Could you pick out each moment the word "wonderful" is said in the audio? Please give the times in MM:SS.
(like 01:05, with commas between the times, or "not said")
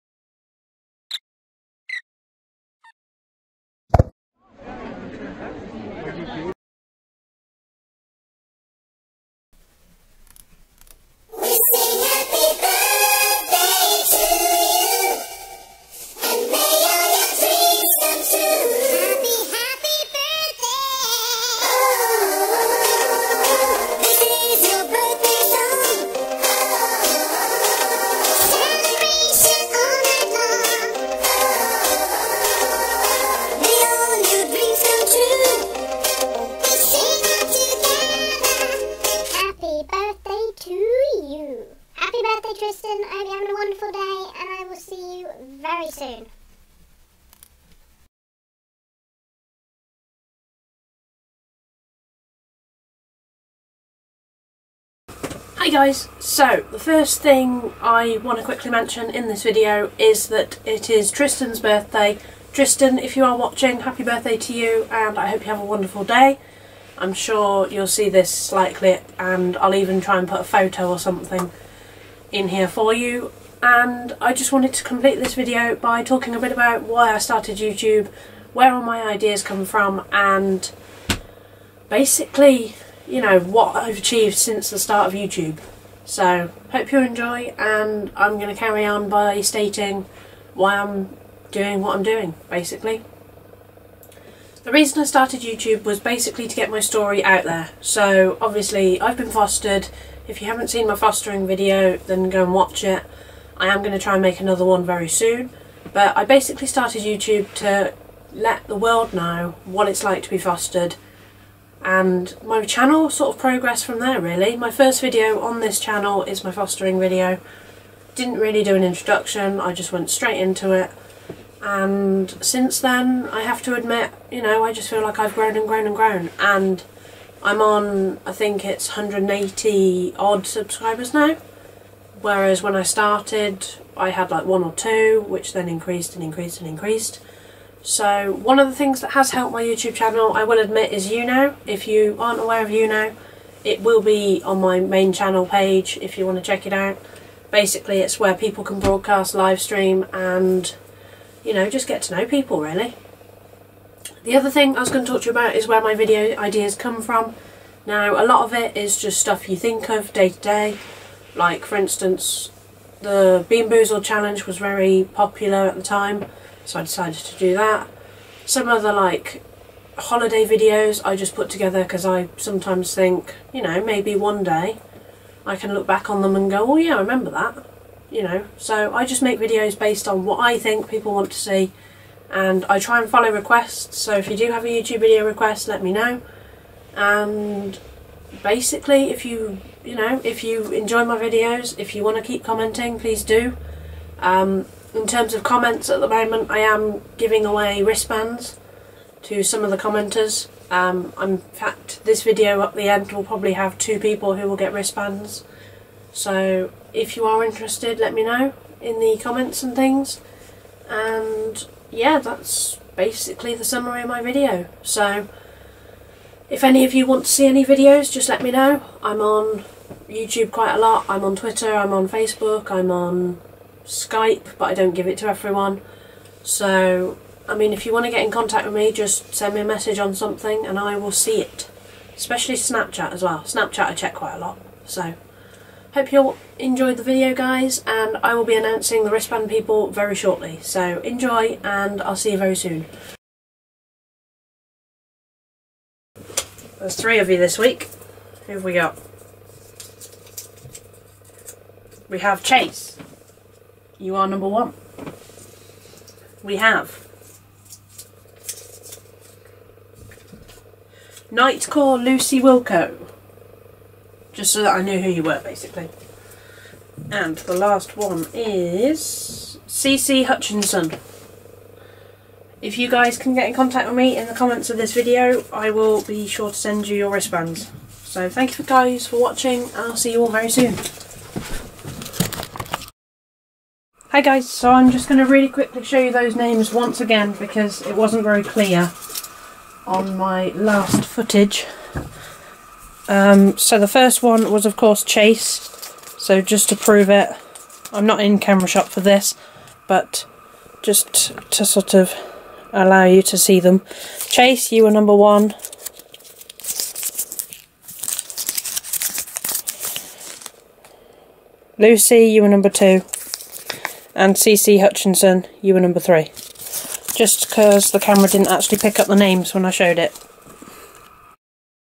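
00:43, 01:05.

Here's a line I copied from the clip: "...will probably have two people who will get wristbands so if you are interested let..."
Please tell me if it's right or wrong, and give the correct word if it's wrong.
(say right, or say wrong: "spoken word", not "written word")
right.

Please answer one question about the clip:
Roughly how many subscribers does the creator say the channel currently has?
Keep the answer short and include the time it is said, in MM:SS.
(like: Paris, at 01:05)
180, at 02:08.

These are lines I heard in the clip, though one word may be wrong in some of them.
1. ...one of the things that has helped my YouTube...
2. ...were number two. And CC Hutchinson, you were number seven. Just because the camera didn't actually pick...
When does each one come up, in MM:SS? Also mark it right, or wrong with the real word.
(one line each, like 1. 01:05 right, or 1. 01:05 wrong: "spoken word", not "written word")
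1. 02:18 right
2. 05:12 wrong: "three", not "seven".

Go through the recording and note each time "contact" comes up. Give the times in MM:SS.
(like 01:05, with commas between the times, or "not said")
03:48, 04:33.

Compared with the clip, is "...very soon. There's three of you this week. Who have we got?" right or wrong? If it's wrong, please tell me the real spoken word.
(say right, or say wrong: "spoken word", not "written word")
right.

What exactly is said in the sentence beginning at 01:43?
I am going to try and make another one very soon.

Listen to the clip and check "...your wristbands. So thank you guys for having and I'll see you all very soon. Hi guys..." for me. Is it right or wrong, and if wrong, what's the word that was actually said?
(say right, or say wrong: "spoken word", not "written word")
wrong: "watching", not "having".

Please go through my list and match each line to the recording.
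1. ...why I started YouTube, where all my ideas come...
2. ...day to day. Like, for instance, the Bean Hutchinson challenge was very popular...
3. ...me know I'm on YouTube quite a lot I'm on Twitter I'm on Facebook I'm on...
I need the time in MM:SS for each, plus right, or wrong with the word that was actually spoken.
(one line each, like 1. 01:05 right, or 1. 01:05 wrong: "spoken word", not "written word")
1. 01:16 right
2. 02:40 wrong: "Boozle", not "Hutchinson"
3. 03:38 right.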